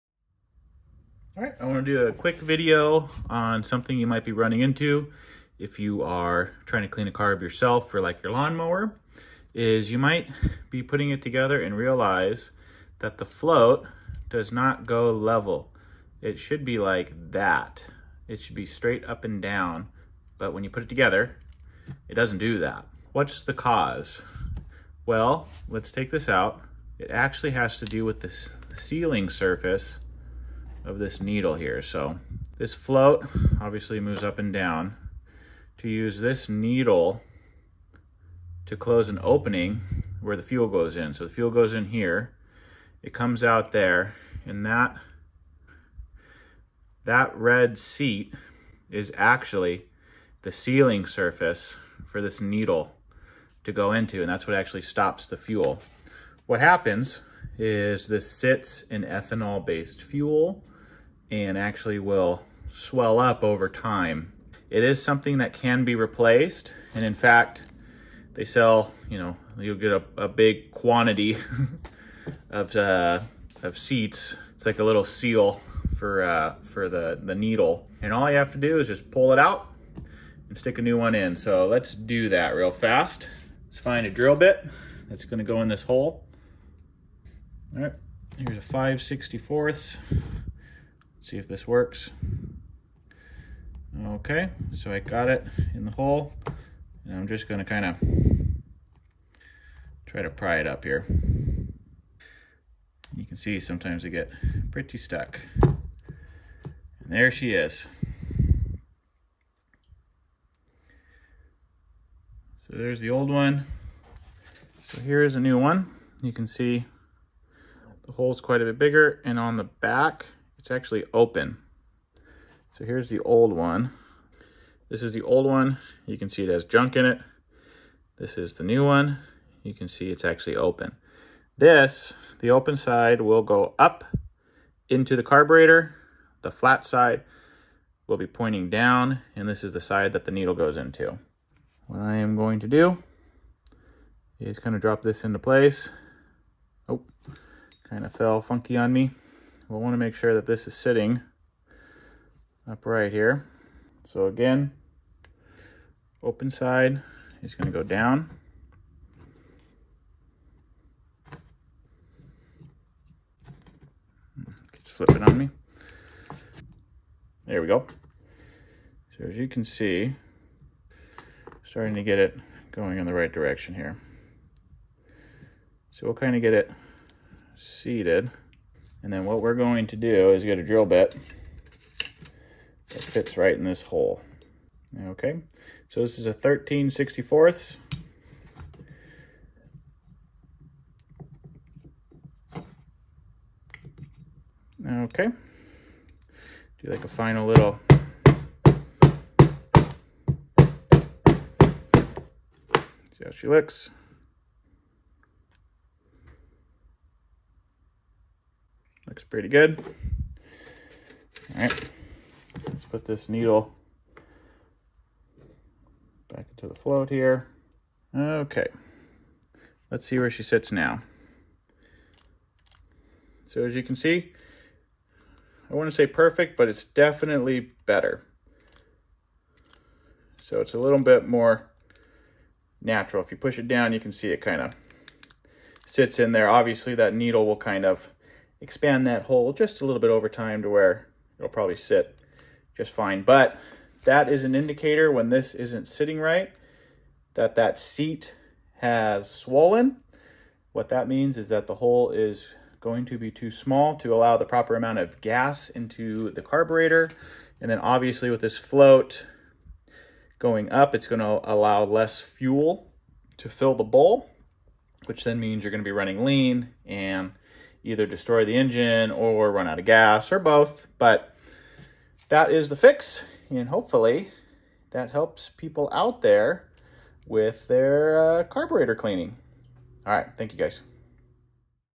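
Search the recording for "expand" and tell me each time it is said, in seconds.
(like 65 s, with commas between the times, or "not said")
238 s.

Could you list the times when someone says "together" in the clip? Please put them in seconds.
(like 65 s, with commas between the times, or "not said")
11 s, 20 s.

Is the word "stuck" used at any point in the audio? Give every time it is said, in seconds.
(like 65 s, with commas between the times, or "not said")
104 s.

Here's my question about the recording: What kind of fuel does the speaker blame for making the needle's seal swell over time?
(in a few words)
Ethanol-based fuel.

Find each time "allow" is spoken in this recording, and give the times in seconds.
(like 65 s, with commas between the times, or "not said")
254 s, 261 s.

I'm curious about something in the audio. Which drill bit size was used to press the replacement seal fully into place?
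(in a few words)
13/64.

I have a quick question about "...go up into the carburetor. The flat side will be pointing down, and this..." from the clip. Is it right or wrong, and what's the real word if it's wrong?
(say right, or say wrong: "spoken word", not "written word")
right.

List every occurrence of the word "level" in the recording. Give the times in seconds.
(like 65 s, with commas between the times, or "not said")
15 s.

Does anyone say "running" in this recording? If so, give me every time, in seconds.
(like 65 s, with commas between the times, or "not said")
4 s, 265 s.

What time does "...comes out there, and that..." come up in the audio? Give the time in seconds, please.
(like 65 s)
43 s.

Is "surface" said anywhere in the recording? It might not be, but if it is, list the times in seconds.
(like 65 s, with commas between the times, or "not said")
29 s, 51 s.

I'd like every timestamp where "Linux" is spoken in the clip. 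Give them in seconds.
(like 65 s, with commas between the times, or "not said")
not said.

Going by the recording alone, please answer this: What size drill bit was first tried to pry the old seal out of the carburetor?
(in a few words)
5/64.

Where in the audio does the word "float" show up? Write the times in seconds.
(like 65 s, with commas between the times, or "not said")
13 s, 32 s, 216 s, 258 s.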